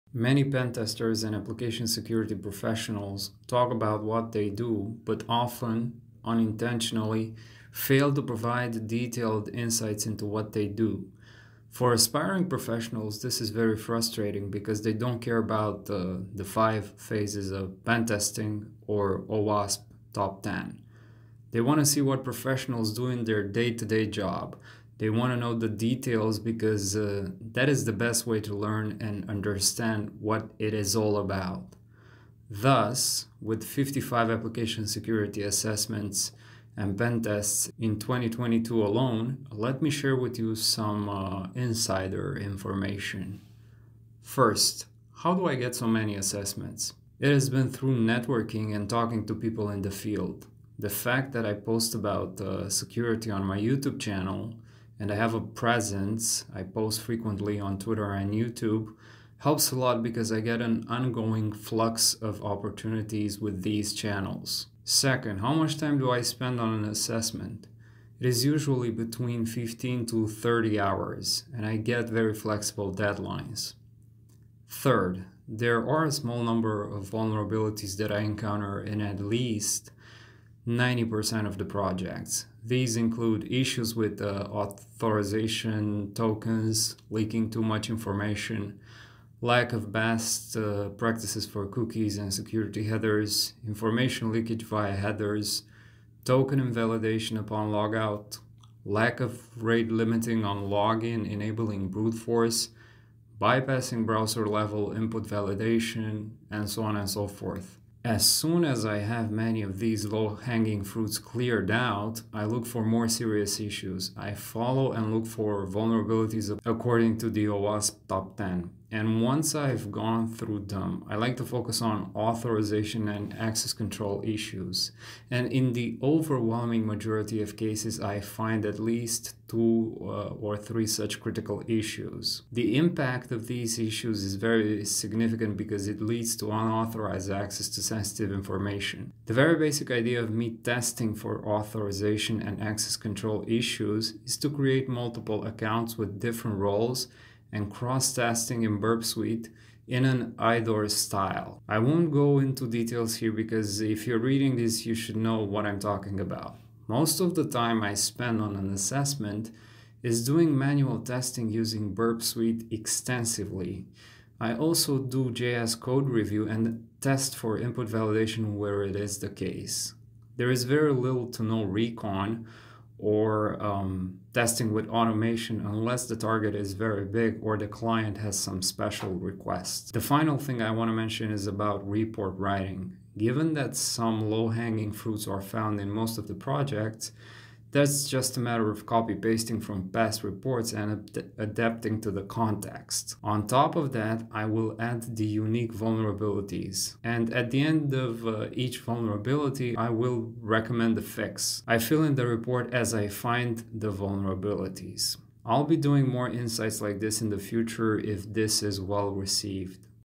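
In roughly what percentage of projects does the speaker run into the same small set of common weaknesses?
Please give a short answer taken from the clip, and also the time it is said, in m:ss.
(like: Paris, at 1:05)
90%, at 1:20.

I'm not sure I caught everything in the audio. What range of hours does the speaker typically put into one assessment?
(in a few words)
15 to 30 hours.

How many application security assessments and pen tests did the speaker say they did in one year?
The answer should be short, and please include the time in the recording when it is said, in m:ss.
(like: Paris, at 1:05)
55, at 0:33.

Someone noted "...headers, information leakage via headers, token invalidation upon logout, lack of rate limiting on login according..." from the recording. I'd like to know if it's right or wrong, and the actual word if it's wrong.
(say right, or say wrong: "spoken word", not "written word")
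wrong: "enabling", not "according".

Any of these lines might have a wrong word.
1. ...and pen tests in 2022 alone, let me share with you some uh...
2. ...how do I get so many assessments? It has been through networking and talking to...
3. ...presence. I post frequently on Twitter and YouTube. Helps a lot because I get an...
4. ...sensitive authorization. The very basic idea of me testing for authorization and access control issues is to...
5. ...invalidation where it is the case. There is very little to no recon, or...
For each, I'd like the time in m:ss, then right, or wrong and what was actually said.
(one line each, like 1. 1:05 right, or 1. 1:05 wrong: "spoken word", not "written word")
1. 0:36 right
2. 0:45 right
3. 0:55 right
4. 2:17 wrong: "information", not "authorization"
5. 2:47 wrong: "validation", not "invalidation".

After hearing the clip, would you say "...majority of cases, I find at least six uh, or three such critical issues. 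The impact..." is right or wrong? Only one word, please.
wrong.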